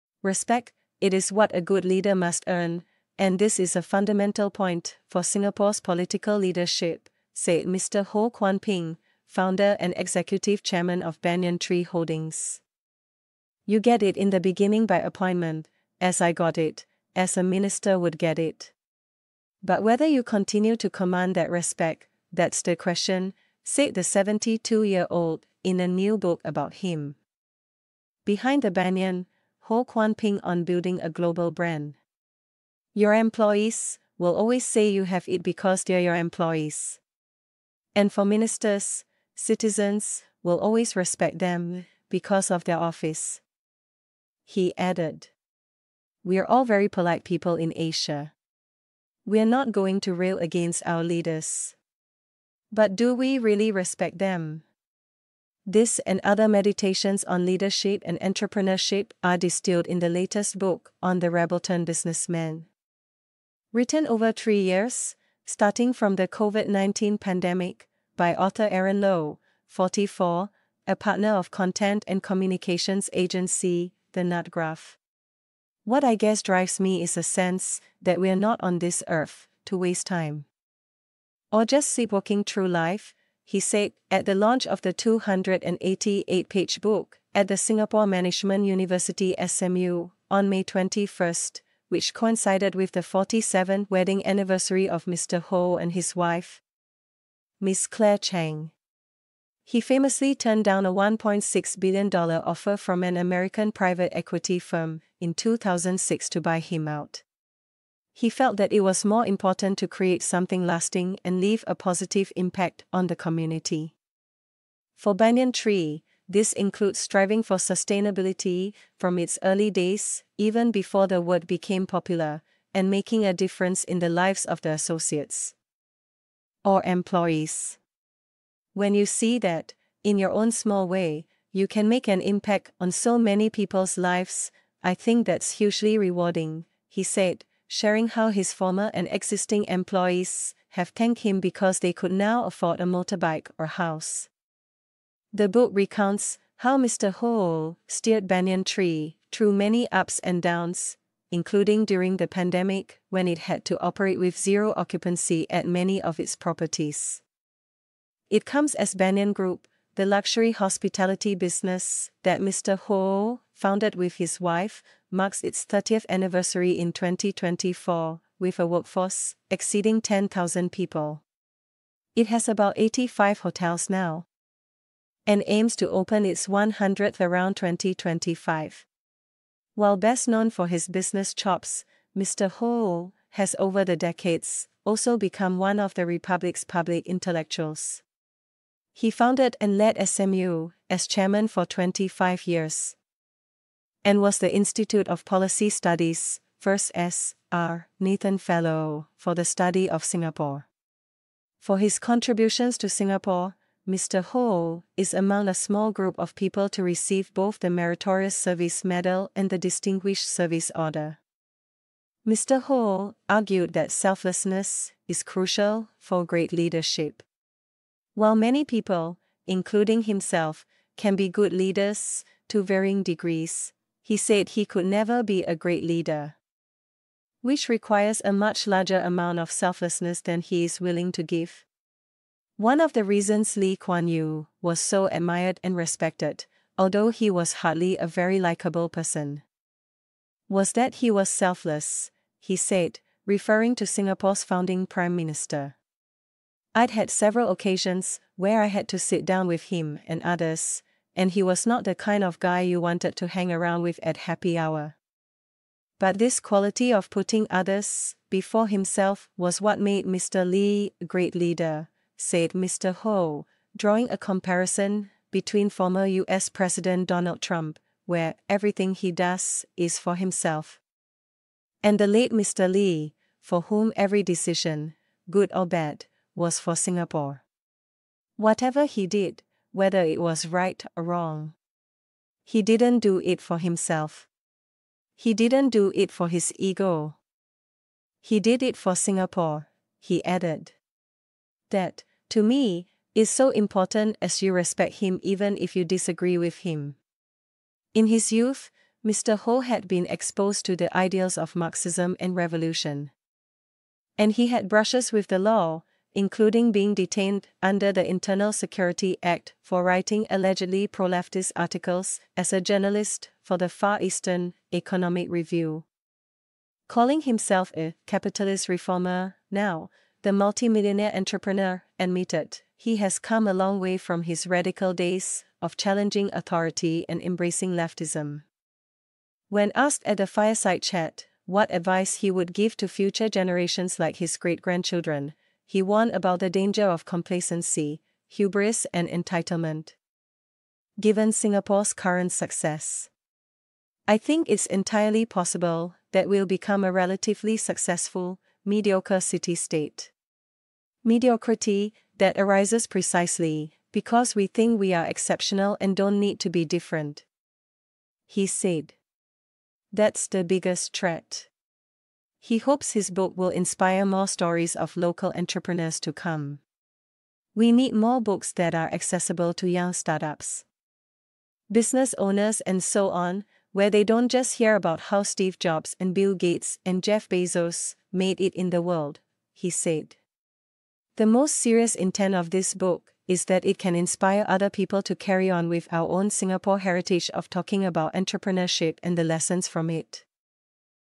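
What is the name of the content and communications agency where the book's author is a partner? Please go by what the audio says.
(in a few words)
The Nutgraph.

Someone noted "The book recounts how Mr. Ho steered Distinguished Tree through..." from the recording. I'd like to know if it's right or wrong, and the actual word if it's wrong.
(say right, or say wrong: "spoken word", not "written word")
wrong: "Banyan", not "Distinguished".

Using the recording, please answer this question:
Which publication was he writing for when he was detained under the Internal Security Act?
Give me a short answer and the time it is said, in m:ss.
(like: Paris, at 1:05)
Far Eastern Economic Review, at 5:13.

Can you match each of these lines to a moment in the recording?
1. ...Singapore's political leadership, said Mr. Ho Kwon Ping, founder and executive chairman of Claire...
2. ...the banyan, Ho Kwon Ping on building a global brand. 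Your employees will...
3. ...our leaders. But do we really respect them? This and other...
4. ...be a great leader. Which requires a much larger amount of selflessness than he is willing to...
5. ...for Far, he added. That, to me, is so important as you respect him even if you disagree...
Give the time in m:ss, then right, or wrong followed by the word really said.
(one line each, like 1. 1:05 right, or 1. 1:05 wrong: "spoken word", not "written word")
1. 0:05 wrong: "Banyan", not "Claire"
2. 0:28 right
3. 0:50 right
4. 3:45 right
5. 4:48 wrong: "Singapore", not "Far".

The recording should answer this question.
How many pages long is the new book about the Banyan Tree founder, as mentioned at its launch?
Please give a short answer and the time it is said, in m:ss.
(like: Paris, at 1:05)
288, at 1:24.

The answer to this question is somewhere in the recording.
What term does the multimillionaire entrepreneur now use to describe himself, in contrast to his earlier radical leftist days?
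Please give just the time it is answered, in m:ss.
5:18.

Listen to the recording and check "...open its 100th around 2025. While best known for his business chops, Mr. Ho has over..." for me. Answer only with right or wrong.
right.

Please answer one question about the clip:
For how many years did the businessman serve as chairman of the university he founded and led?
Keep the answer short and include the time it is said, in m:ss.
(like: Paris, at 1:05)
25, at 3:11.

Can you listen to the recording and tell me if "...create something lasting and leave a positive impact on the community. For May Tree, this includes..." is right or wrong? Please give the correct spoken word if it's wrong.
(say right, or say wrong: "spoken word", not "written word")
wrong: "Banyan", not "May".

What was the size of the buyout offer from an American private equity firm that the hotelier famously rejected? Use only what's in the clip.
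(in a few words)
$1.6 billion.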